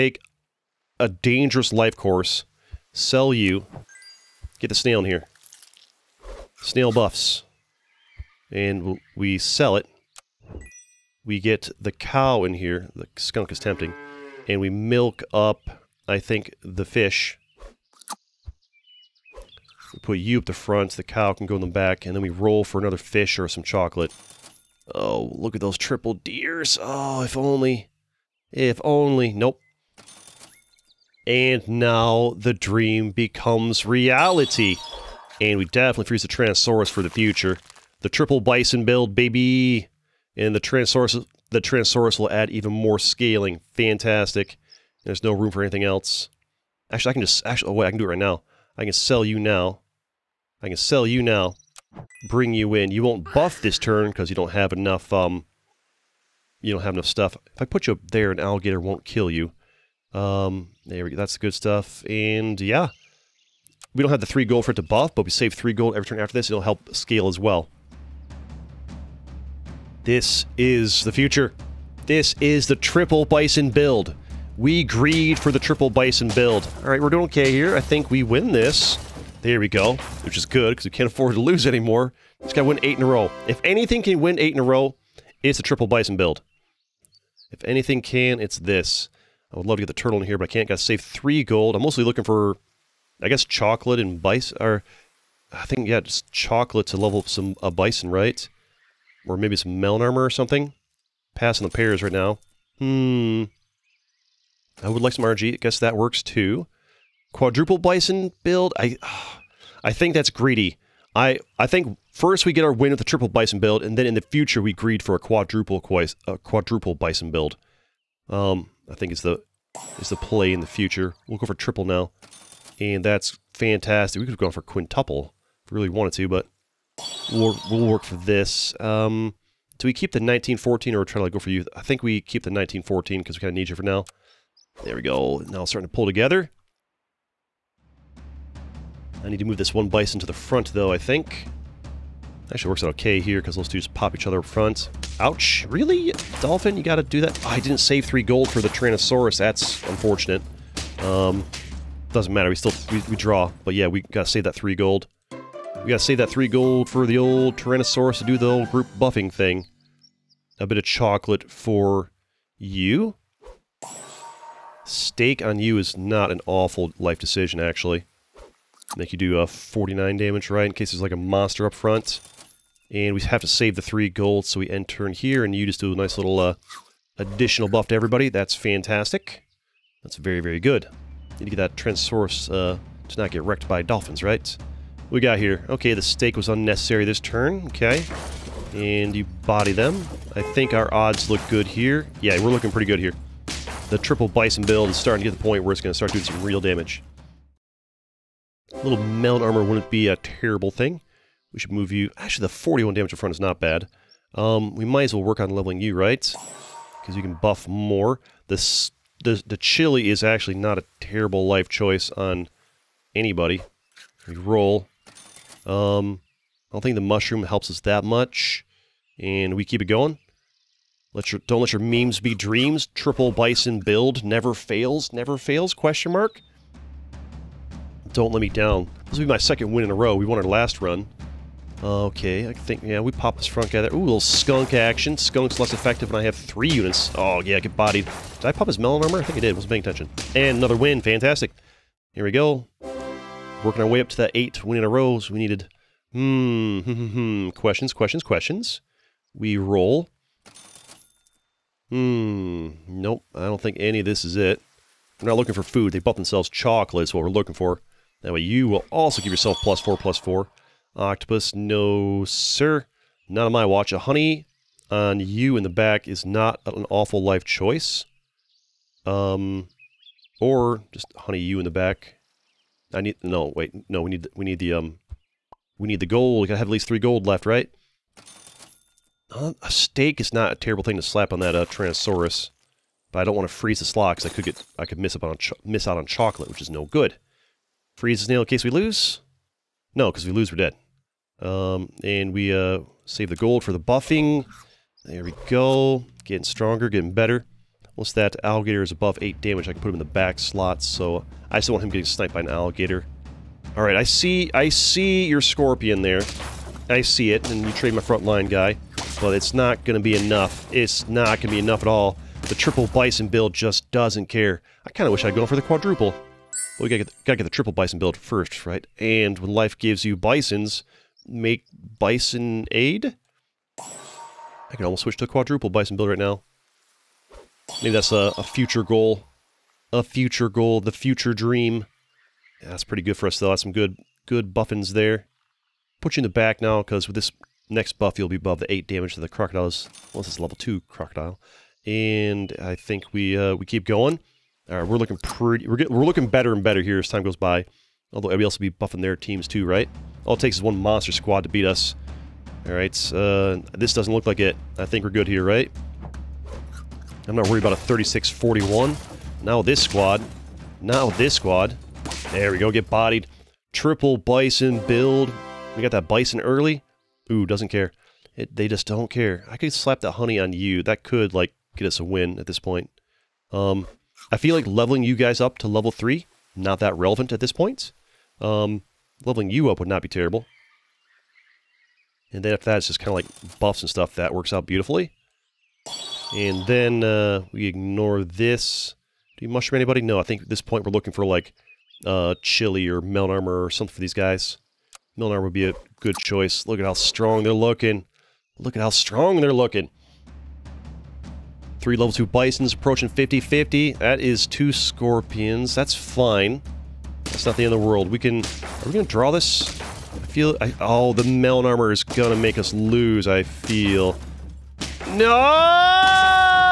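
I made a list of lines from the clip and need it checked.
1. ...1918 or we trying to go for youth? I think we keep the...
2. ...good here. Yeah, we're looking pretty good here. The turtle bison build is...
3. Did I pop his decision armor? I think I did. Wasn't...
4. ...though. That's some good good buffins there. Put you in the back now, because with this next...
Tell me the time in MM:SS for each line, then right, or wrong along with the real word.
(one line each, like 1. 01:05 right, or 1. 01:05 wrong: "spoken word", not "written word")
1. 02:10 wrong: "1914", not "1918"
2. 03:11 wrong: "triple", not "turtle"
3. 03:58 wrong: "melon", not "decision"
4. 05:33 right.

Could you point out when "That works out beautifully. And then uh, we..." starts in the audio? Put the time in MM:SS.
06:24.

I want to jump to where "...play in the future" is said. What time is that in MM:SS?
02:00.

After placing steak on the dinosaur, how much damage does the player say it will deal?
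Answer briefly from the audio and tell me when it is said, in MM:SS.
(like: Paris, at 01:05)
49, at 02:49.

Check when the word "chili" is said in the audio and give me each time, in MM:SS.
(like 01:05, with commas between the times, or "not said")
03:29, 06:32.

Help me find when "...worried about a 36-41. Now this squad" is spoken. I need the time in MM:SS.
05:57.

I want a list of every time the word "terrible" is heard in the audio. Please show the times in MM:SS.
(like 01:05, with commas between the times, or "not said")
03:20, 03:30, 04:40, 06:20.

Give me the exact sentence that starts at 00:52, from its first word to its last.
You won't buff this turn because you don't have enough um, you don't have enough stuff.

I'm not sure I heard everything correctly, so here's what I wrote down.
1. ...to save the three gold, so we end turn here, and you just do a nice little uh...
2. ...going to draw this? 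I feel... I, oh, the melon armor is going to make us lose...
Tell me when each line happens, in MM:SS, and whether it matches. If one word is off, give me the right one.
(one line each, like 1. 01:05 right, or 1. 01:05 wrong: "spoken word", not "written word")
1. 02:53 right
2. 06:48 right.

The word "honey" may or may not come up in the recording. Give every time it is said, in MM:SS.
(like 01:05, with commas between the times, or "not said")
04:23, 04:31, 06:10.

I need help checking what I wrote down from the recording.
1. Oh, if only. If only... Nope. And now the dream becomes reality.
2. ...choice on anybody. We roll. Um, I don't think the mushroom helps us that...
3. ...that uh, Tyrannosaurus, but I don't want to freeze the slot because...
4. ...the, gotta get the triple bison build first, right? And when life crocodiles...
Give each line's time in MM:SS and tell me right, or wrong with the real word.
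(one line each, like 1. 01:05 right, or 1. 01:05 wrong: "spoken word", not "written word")
1. 00:26 right
2. 03:31 right
3. 04:41 right
4. 05:17 wrong: "gives", not "crocodiles".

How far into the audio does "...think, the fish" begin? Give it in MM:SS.
00:16.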